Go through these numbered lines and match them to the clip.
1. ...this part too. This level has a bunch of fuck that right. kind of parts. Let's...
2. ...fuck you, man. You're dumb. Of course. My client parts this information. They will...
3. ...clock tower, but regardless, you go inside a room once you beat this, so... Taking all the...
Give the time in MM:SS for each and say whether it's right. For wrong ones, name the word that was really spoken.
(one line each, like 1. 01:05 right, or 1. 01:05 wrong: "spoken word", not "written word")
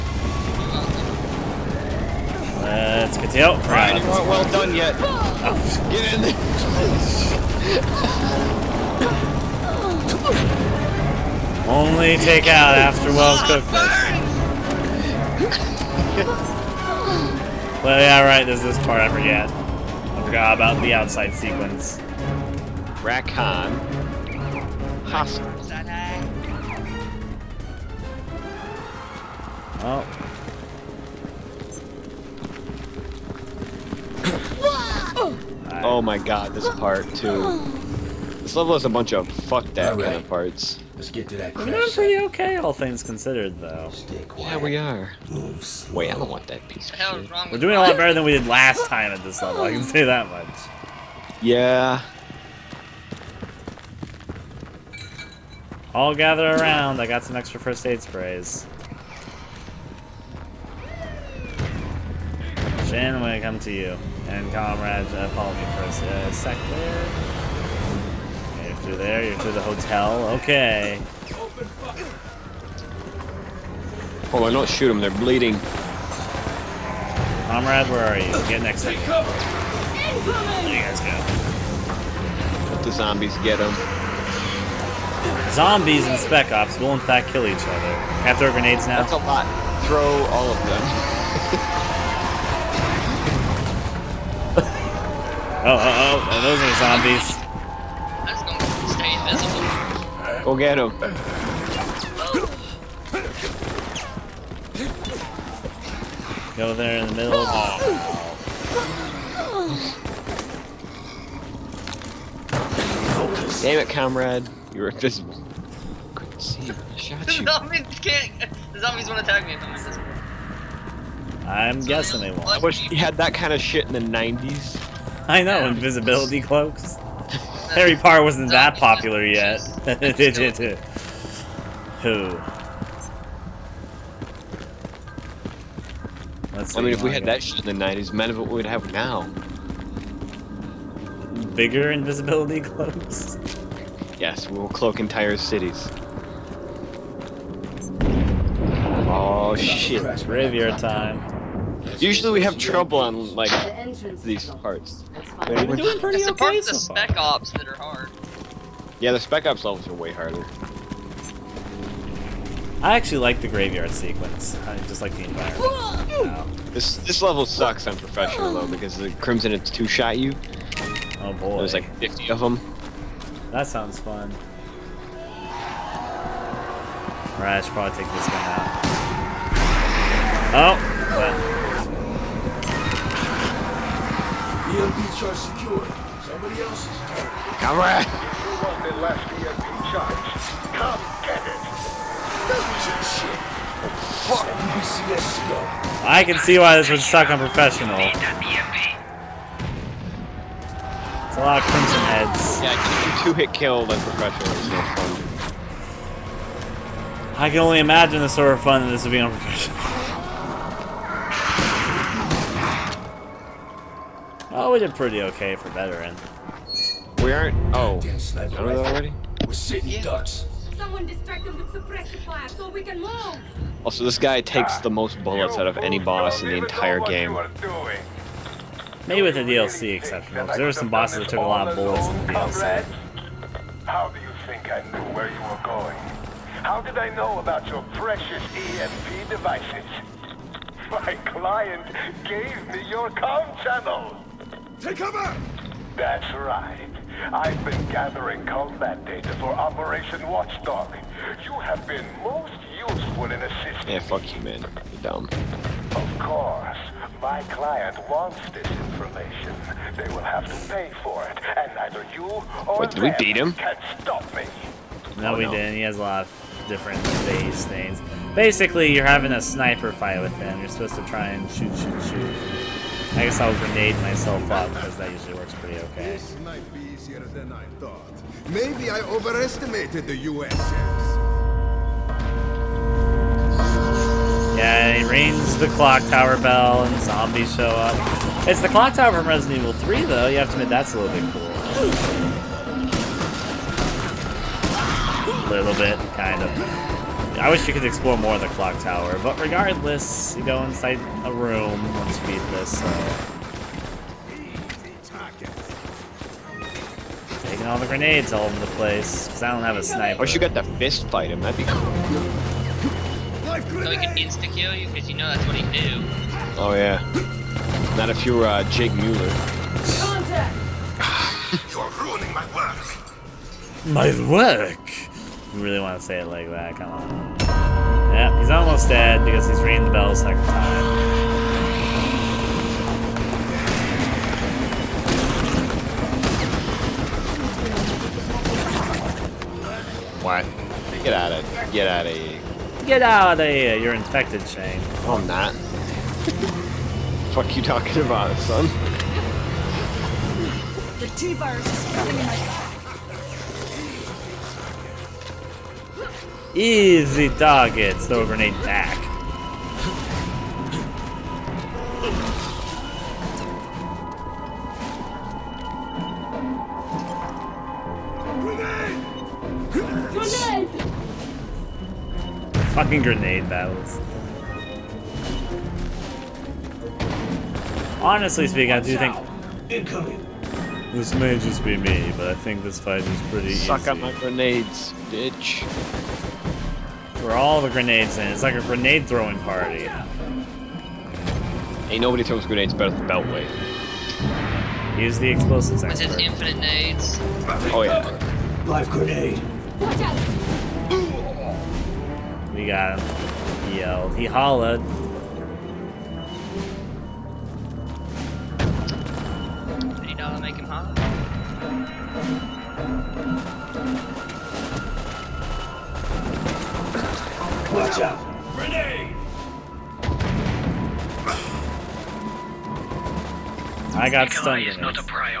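1. 00:36 right
2. 04:14 wrong: "wants", not "parts"
3. 04:58 right.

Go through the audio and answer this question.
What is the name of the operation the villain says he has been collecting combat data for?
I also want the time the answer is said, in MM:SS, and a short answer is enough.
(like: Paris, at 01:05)
Operation Watchdog, at 04:09.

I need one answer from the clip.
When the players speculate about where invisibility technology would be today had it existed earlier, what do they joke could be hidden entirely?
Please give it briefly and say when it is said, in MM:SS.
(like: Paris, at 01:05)
entire cities, at 02:24.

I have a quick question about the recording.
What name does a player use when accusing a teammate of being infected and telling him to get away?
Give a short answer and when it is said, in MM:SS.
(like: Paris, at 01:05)
Shane, at 05:44.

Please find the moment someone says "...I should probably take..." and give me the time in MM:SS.
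02:57.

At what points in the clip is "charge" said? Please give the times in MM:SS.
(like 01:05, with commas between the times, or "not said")
03:05, 03:09.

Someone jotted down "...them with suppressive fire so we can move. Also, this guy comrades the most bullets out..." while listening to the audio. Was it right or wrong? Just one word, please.
wrong.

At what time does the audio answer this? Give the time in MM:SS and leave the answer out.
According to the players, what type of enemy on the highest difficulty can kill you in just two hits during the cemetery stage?
03:21.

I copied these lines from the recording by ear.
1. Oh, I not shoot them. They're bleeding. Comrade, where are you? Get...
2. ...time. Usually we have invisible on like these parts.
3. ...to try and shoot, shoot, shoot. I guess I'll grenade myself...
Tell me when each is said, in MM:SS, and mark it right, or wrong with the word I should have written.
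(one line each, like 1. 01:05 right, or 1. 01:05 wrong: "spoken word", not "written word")
1. 01:14 right
2. 02:30 wrong: "trouble", not "invisible"
3. 04:30 right.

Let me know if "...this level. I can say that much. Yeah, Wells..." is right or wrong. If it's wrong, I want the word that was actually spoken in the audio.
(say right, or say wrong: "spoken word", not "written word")
wrong: "All", not "Wells".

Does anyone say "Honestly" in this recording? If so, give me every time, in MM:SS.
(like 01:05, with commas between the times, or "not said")
06:18.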